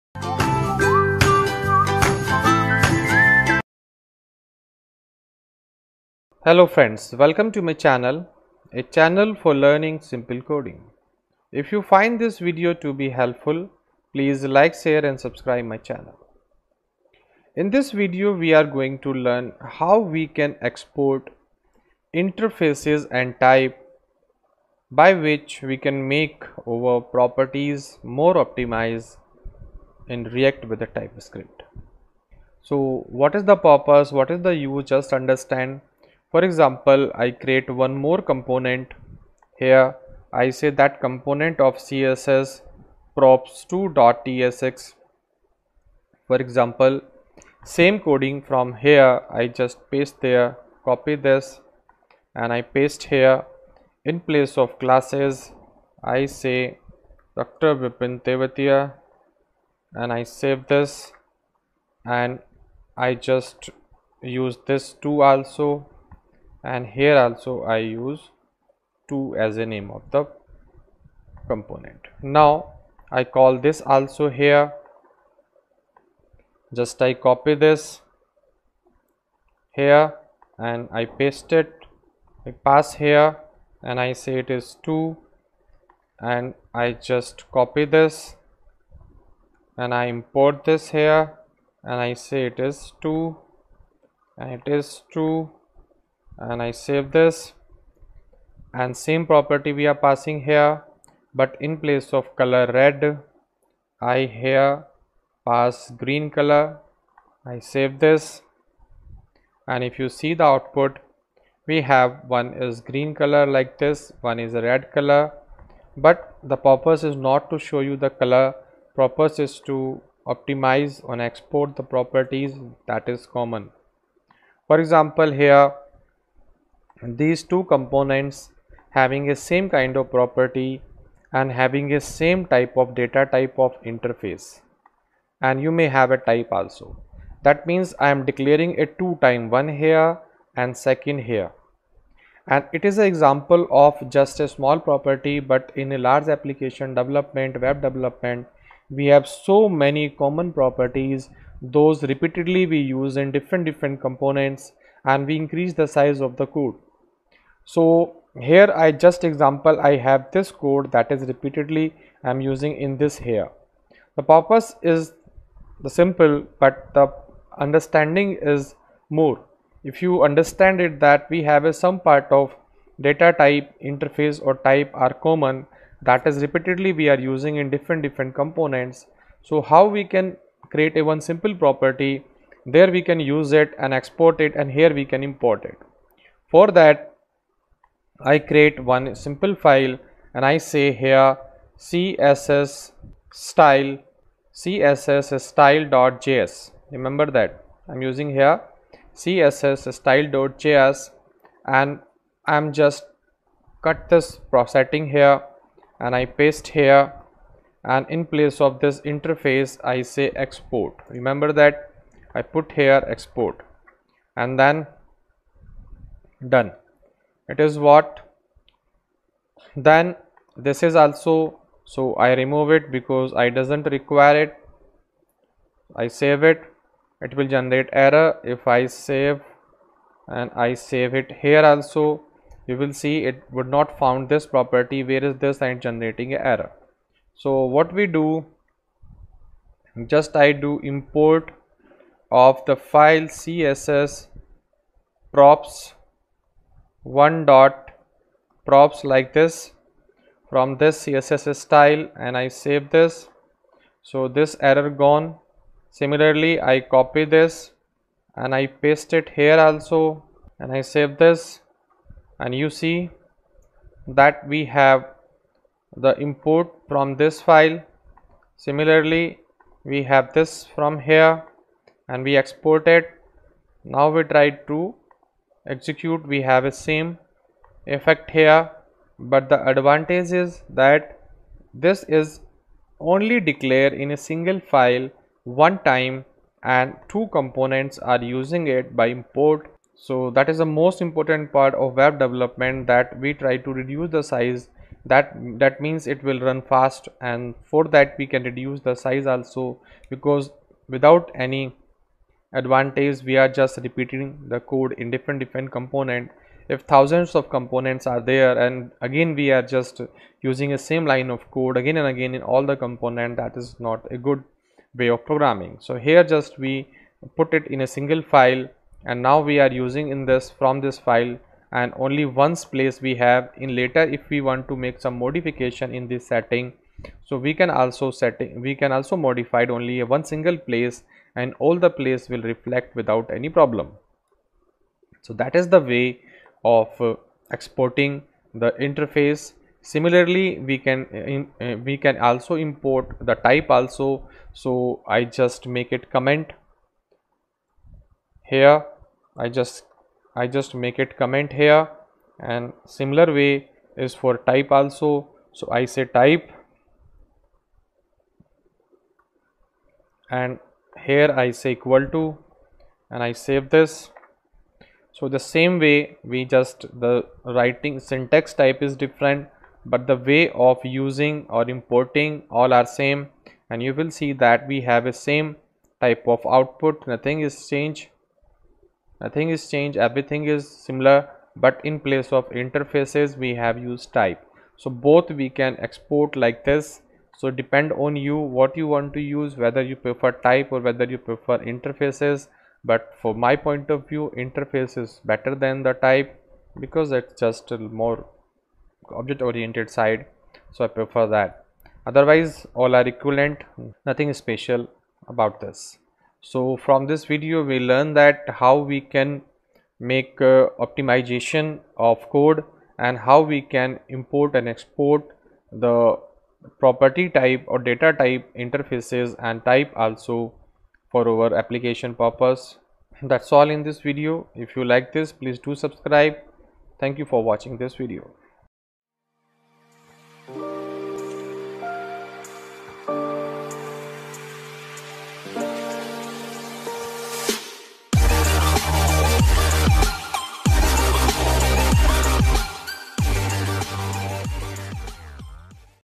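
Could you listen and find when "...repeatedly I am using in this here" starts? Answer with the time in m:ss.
2:41.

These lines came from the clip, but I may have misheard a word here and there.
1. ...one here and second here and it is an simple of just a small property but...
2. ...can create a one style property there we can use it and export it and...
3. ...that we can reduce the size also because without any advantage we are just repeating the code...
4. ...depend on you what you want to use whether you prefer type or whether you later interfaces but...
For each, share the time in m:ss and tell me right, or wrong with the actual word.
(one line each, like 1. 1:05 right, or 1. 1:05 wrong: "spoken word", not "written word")
1. 2:19 wrong: "example", not "simple"
2. 3:00 wrong: "simple", not "style"
3. 4:57 right
4. 6:27 wrong: "prefer", not "later".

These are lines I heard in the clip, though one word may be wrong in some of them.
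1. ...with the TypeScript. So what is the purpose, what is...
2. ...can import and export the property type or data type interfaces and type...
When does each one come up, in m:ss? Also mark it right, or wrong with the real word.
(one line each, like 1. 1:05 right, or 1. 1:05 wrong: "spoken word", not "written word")
1. 0:30 right
2. 6:53 right.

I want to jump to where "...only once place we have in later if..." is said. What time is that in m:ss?
5:21.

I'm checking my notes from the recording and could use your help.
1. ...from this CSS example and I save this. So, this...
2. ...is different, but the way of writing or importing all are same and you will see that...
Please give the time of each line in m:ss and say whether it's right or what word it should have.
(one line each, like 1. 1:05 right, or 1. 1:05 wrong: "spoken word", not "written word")
1. 4:10 wrong: "style", not "example"
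2. 6:08 wrong: "using", not "writing".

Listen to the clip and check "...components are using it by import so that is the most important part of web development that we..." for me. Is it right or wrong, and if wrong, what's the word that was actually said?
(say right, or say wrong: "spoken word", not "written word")
right.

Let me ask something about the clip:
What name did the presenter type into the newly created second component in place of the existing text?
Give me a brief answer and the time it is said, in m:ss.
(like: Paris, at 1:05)
Dr. Vipin, at 0:57.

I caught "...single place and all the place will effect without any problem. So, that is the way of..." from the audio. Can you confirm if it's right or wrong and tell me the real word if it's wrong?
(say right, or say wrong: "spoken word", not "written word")
wrong: "reflect", not "effect".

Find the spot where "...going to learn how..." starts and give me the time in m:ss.
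0:18.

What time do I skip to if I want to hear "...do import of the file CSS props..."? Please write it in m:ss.
4:00.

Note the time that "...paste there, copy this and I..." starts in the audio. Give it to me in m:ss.
0:49.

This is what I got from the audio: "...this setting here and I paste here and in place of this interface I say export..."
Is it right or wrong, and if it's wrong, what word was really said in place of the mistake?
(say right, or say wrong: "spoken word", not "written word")
right.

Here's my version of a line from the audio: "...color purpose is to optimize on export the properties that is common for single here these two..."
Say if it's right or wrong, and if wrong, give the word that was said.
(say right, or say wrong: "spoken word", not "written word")
wrong: "example", not "single".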